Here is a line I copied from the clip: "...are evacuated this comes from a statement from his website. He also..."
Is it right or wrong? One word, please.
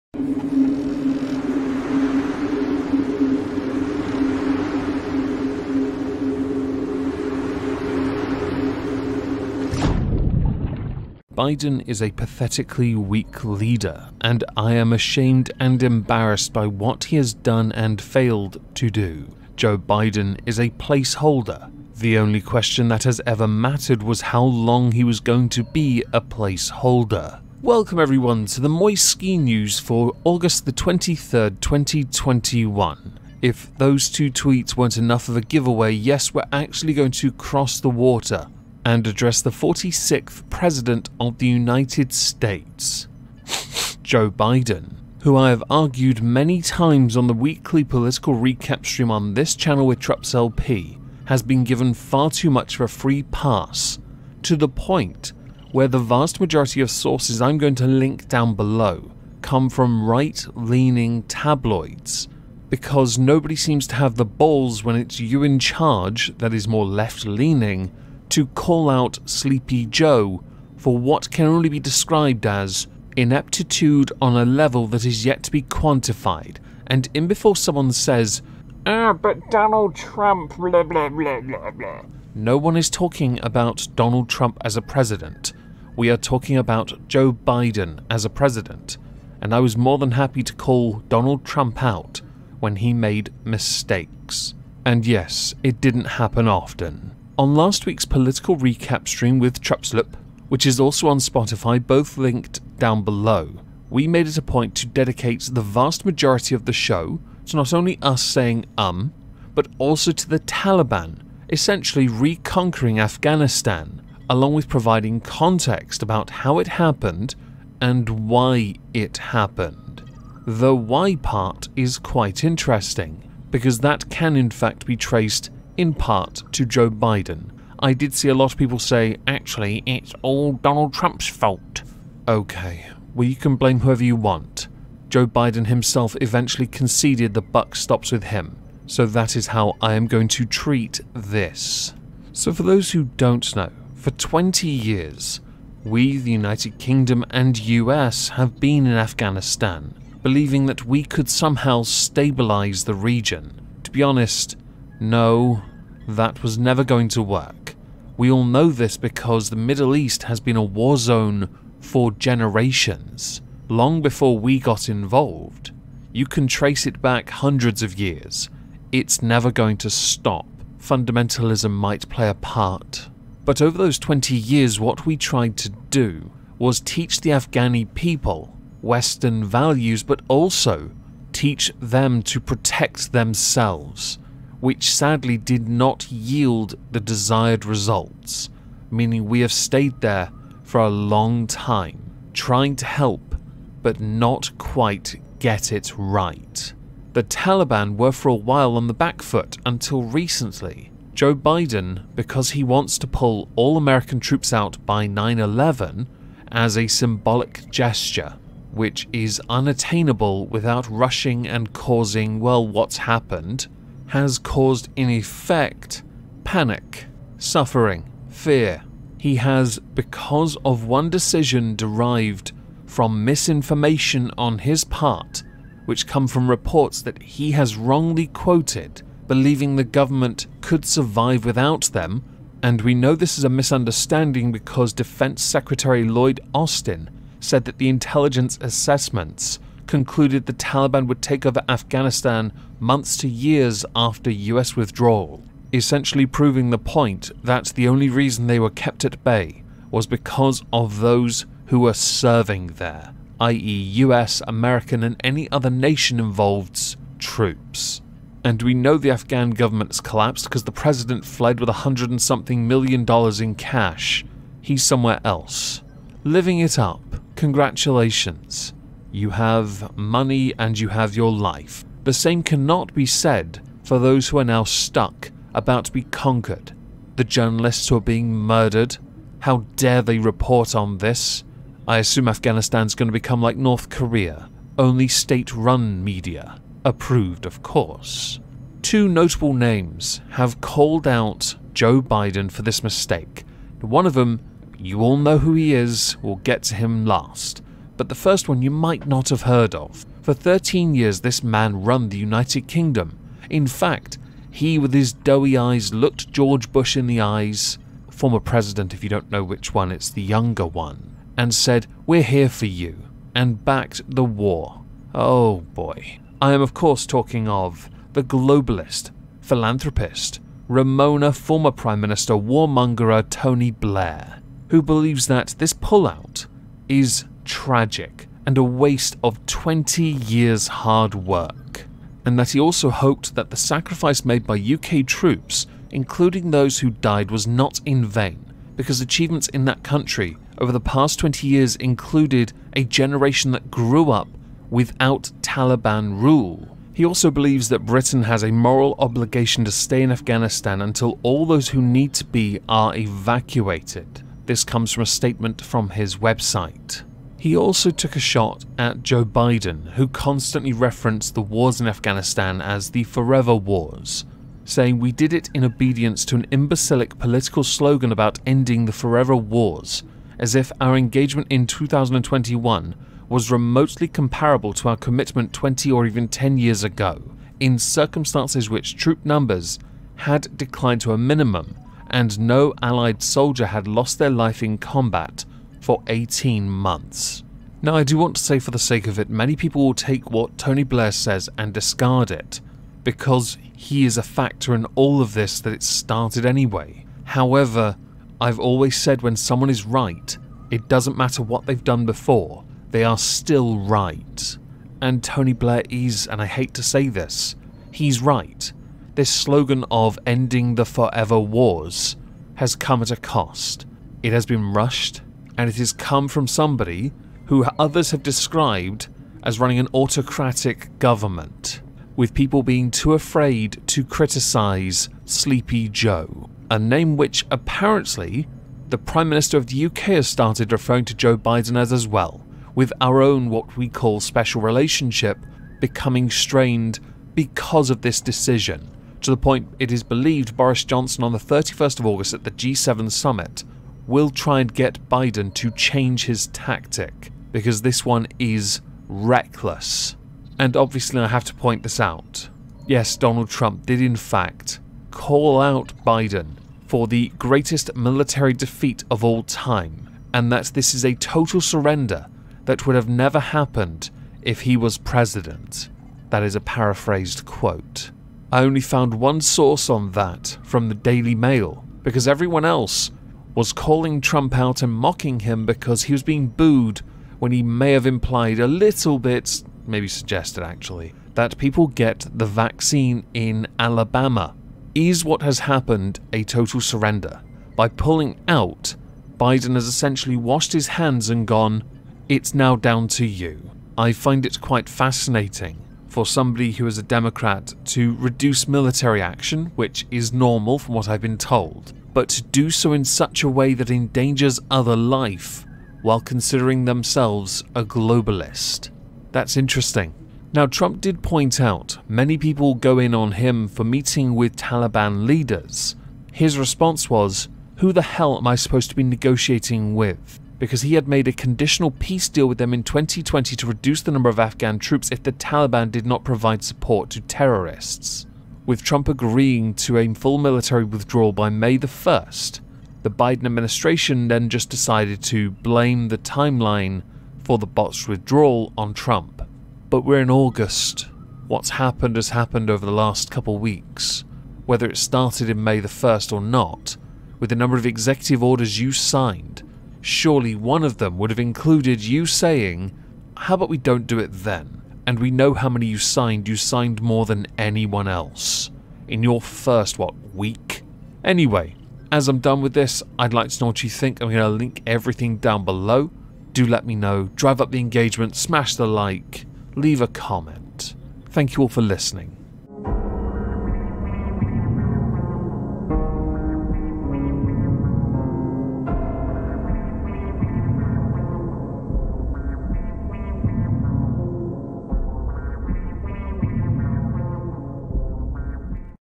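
right.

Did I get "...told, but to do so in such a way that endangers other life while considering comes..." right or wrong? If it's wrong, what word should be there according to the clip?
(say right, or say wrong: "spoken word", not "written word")
wrong: "themselves", not "comes".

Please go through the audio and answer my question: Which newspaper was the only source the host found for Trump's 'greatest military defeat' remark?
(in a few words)
Daily Mail.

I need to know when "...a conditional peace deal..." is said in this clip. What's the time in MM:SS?
08:41.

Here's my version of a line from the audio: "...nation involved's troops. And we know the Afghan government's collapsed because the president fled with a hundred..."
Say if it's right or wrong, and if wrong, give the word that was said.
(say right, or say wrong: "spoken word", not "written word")
right.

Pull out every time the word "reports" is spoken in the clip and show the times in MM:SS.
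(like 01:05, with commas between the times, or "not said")
03:46, 04:40.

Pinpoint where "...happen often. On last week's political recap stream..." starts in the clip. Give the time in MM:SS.
01:36.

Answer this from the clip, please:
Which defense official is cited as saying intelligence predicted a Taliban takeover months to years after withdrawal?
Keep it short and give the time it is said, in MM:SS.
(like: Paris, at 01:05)
Lloyd Austin, at 03:56.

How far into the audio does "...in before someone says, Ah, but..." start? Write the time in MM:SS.
01:17.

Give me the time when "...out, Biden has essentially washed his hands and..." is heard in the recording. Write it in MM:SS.
08:08.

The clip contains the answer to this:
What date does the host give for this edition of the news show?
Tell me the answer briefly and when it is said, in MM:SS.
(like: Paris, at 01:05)
August 23rd, 2021, at 00:30.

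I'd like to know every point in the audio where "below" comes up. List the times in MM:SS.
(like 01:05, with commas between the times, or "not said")
00:58, 01:43, 09:25.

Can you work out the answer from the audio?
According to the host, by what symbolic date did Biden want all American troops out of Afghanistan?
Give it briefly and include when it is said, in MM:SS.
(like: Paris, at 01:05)
9/11, at 03:25.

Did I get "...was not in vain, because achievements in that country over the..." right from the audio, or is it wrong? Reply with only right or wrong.
right.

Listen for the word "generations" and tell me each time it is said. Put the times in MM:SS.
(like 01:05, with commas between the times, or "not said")
02:42, 05:42.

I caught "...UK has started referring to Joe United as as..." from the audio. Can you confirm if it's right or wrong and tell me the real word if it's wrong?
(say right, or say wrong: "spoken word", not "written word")
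wrong: "Biden", not "United".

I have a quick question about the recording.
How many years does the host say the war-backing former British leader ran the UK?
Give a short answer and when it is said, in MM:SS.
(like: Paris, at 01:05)
13, at 05:00.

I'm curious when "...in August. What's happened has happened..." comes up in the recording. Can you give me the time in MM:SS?
09:00.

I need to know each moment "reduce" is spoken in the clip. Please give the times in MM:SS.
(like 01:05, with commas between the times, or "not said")
08:18, 08:43.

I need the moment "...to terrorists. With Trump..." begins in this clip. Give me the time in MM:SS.
08:47.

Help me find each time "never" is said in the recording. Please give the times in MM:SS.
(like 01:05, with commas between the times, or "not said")
02:36, 02:49, 07:43.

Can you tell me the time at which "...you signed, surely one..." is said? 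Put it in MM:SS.
09:08.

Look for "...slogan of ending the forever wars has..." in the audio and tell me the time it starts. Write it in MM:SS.
06:49.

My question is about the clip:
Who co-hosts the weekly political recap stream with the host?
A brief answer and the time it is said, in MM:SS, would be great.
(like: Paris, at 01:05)
Trups LP, at 00:49.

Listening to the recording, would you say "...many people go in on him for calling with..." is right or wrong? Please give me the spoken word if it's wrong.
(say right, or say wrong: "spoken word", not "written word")
wrong: "meeting", not "calling".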